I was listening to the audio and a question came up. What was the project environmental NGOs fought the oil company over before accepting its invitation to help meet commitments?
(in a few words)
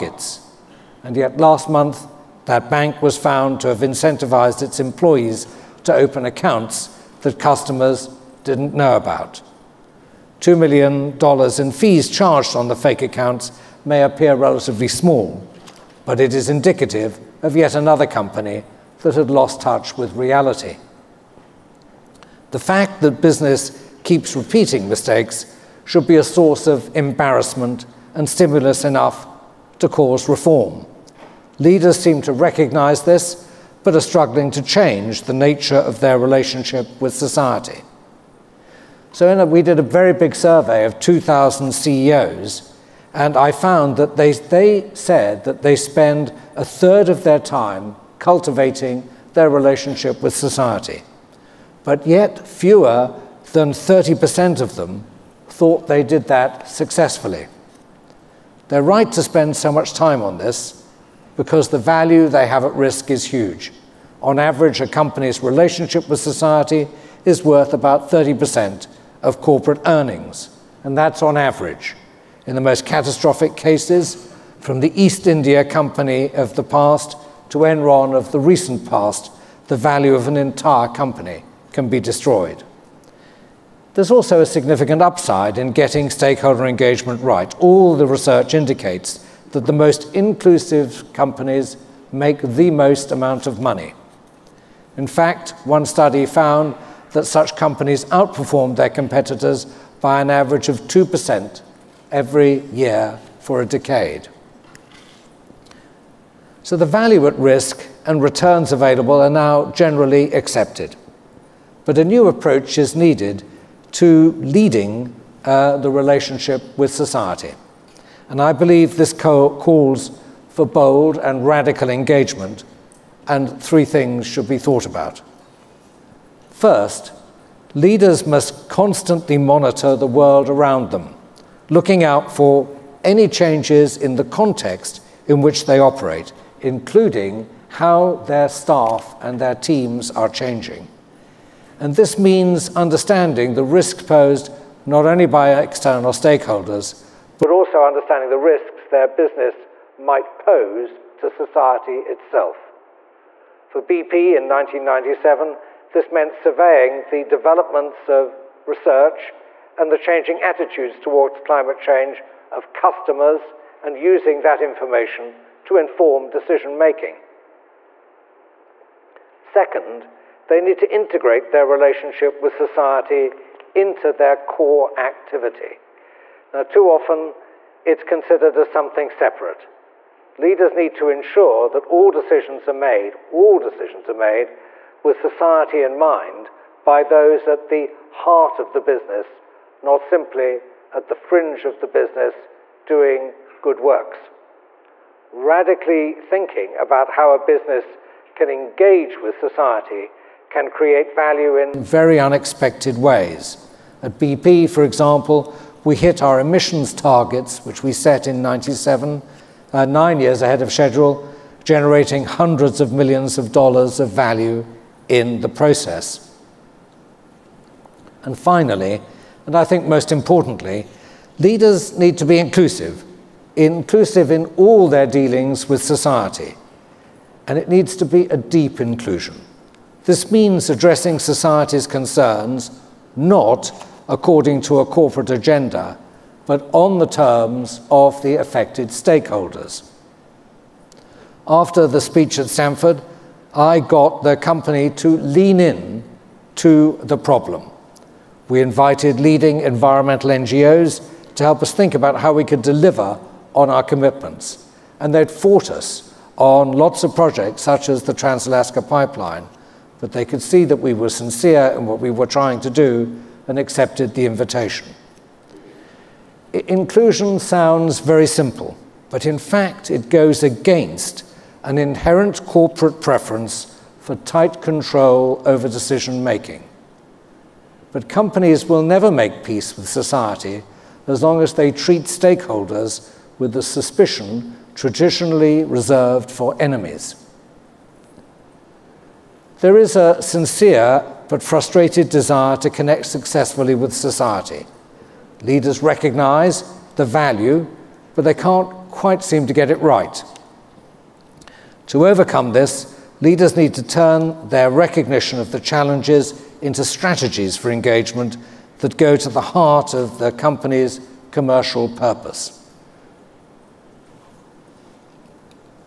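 Trans Alaska Pipeline.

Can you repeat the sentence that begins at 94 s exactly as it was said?
In fact, one study found that such companies outperformed their competitors by an average of 2% every year for a decade.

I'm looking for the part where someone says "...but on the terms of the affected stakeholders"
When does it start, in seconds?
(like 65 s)
236 s.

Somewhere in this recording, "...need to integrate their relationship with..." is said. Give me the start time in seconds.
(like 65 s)
170 s.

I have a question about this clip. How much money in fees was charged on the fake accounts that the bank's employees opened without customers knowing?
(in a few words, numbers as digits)
$2 million.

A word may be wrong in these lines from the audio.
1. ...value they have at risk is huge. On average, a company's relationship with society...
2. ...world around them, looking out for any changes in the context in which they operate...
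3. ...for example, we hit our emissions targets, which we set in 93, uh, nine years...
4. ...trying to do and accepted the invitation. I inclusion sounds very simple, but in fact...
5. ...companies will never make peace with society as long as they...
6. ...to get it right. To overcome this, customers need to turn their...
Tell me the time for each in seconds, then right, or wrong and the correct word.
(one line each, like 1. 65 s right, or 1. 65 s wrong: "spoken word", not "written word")
1. 61 s right
2. 130 s right
3. 204 s wrong: "97", not "93"
4. 262 s right
5. 278 s right
6. 299 s wrong: "leaders", not "customers".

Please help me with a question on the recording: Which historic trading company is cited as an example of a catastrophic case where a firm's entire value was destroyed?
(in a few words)
East India Company.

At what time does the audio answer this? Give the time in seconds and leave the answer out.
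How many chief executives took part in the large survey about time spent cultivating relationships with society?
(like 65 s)
40 s.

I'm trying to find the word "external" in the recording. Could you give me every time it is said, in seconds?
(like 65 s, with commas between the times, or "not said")
145 s.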